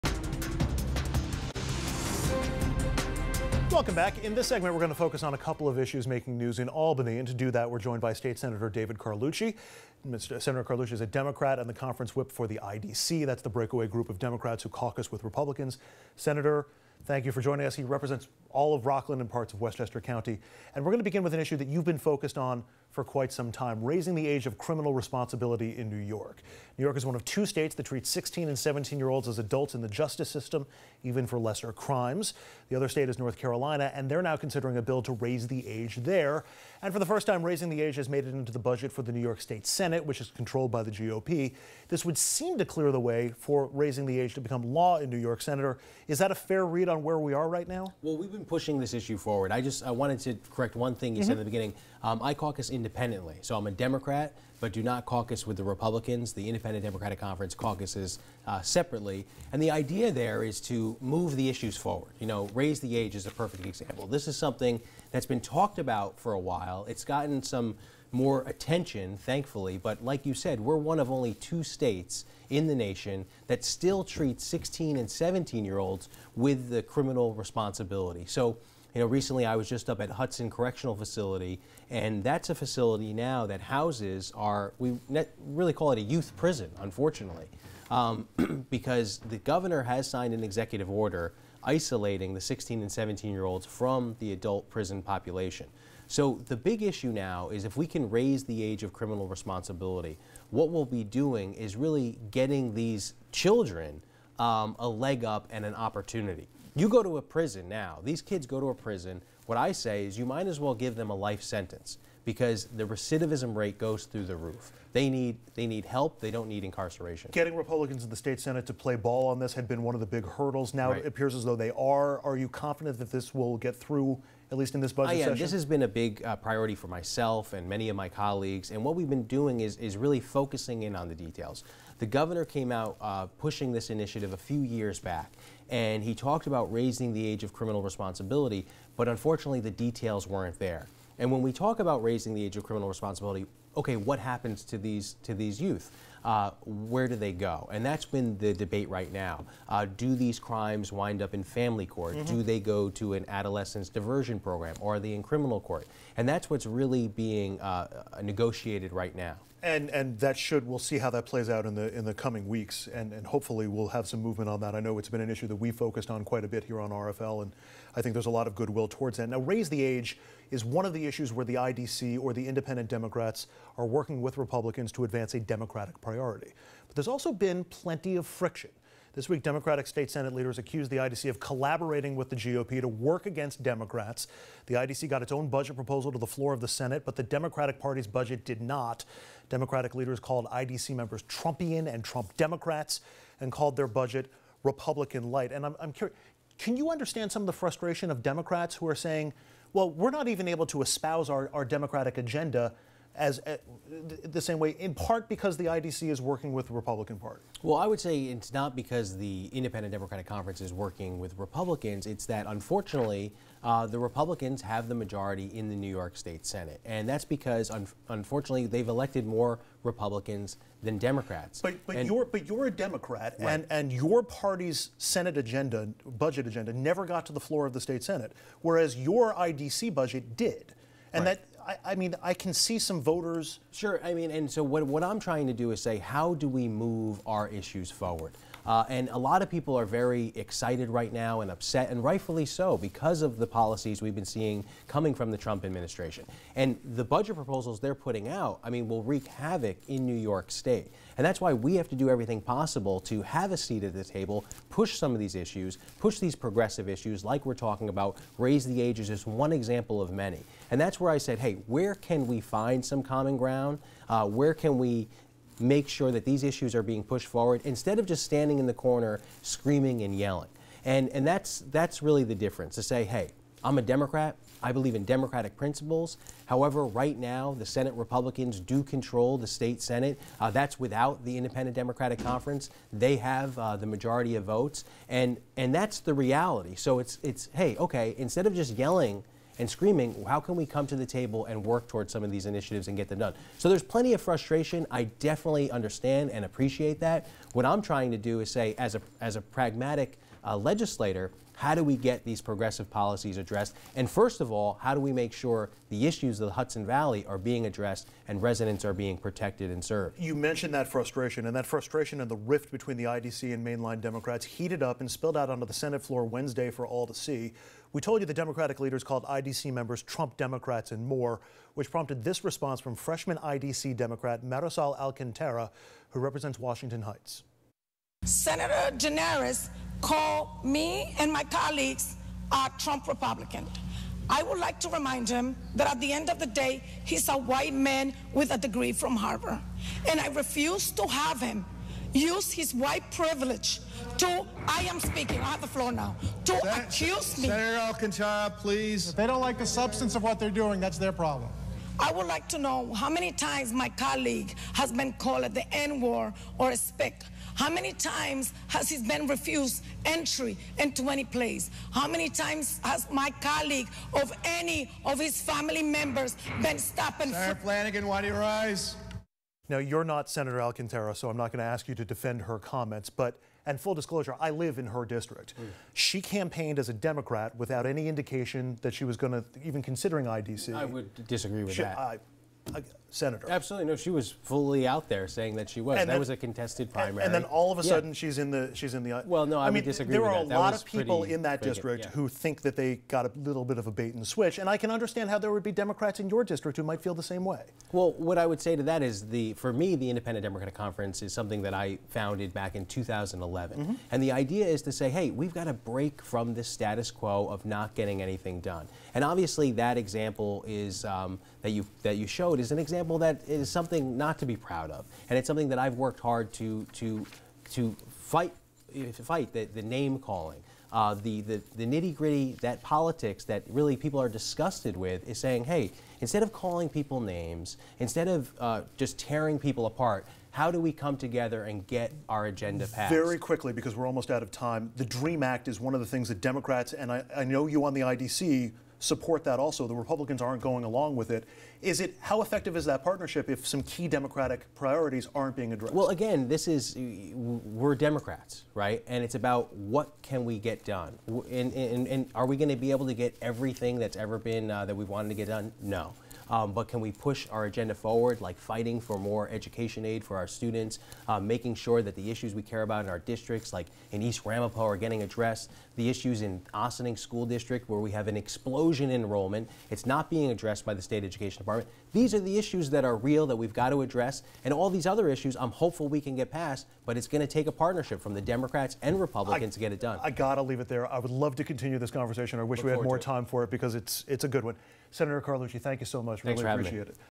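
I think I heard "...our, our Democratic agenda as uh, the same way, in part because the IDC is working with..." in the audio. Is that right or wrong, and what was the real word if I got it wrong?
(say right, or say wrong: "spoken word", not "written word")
right.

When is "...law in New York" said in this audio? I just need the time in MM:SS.
00:44.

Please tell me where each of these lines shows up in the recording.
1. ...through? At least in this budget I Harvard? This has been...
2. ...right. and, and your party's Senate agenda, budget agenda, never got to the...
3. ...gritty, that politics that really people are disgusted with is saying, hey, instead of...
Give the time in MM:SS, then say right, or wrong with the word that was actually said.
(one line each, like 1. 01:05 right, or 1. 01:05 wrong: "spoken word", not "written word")
1. 02:03 wrong: "Session", not "Harvard"
2. 03:43 right
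3. 07:02 right.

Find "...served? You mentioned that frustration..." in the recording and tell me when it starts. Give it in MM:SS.
05:09.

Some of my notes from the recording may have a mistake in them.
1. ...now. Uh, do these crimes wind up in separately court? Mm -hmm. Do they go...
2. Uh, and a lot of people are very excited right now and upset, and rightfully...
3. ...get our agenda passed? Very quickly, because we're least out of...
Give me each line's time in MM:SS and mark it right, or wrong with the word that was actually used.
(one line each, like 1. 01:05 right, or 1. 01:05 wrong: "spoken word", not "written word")
1. 02:29 wrong: "family", not "separately"
2. 03:58 right
3. 07:11 wrong: "almost", not "least".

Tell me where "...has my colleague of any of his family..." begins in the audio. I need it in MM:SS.
06:02.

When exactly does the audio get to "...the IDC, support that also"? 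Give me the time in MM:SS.
07:17.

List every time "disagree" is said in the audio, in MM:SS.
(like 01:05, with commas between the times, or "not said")
06:21, 06:29.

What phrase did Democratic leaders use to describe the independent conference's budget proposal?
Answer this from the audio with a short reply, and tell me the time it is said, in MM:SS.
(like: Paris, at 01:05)
Republican light, at 03:14.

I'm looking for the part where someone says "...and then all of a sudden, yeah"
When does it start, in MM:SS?
06:27.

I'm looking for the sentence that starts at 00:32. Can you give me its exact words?
The other state is North Carolina, and they're now considering a bill to raise the age there.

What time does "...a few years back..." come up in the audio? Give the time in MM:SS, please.
02:14.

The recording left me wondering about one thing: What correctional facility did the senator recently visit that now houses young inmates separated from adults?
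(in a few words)
Hudson Correctional Facility.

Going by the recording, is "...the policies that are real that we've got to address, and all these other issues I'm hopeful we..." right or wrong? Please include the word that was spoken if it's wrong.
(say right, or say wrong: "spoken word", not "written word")
wrong: "issues", not "policies".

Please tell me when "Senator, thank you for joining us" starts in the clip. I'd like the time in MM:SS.
00:16.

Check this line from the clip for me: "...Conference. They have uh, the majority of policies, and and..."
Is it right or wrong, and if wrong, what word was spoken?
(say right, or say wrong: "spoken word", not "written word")
wrong: "votes", not "policies".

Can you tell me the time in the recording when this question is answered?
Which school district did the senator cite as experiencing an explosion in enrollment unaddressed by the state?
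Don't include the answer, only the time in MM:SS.
07:46.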